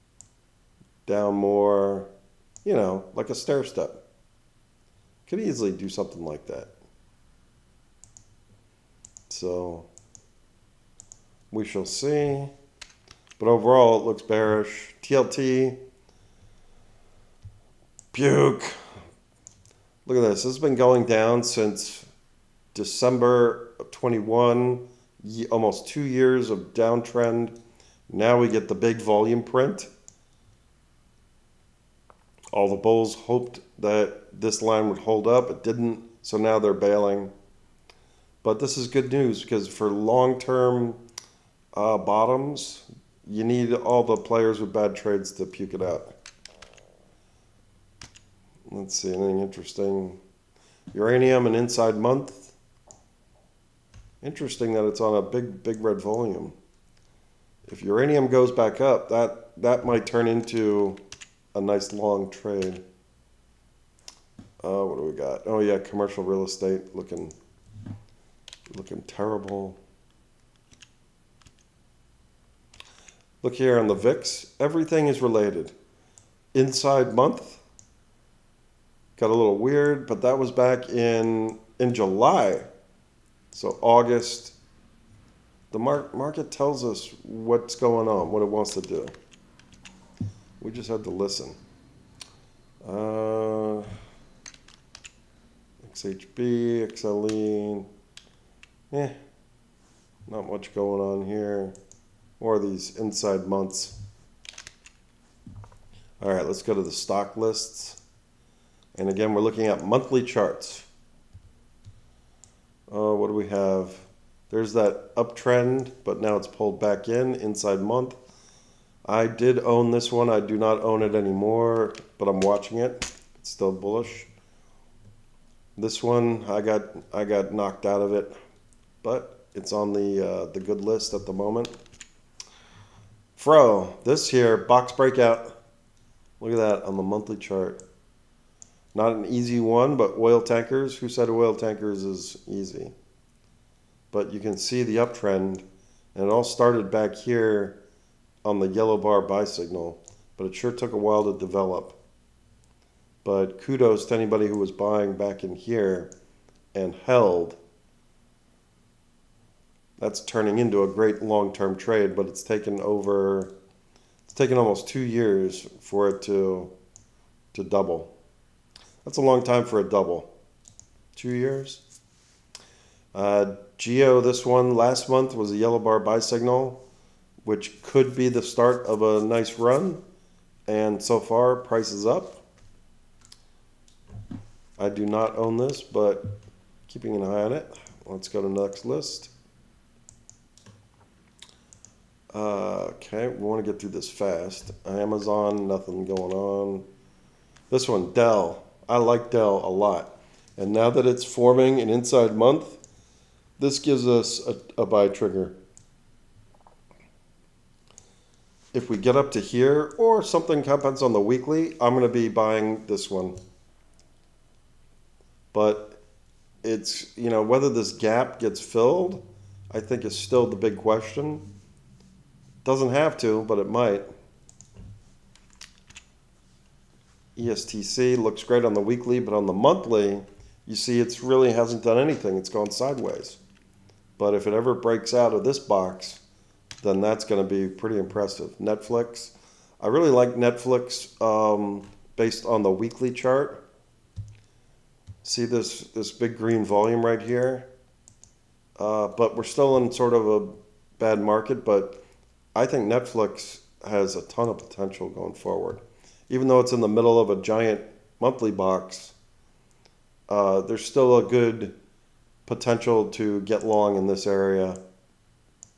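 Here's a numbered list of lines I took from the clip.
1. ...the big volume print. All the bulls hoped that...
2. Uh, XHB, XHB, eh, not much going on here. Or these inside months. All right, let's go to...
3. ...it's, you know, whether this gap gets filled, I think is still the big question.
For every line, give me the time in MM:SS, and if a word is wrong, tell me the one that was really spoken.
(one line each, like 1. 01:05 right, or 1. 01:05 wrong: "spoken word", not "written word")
1. 00:28 right
2. 01:32 wrong: "XLE", not "XHB"
3. 03:36 right.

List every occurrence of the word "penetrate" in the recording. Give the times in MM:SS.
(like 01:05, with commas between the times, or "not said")
not said.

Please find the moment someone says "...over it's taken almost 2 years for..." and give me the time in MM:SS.
02:42.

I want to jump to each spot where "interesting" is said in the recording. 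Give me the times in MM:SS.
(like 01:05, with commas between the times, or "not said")
00:49, 00:54.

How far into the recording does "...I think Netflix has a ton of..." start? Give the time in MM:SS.
04:12.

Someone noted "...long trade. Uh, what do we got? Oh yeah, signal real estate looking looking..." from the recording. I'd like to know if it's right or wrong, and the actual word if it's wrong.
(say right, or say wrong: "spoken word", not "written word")
wrong: "commercial", not "signal".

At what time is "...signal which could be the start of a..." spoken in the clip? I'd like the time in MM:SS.
02:56.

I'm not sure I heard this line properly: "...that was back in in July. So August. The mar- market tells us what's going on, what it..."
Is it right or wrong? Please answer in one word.
right.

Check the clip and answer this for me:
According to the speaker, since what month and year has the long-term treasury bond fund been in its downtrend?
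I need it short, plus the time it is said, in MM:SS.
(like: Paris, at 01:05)
December 2021, at 00:22.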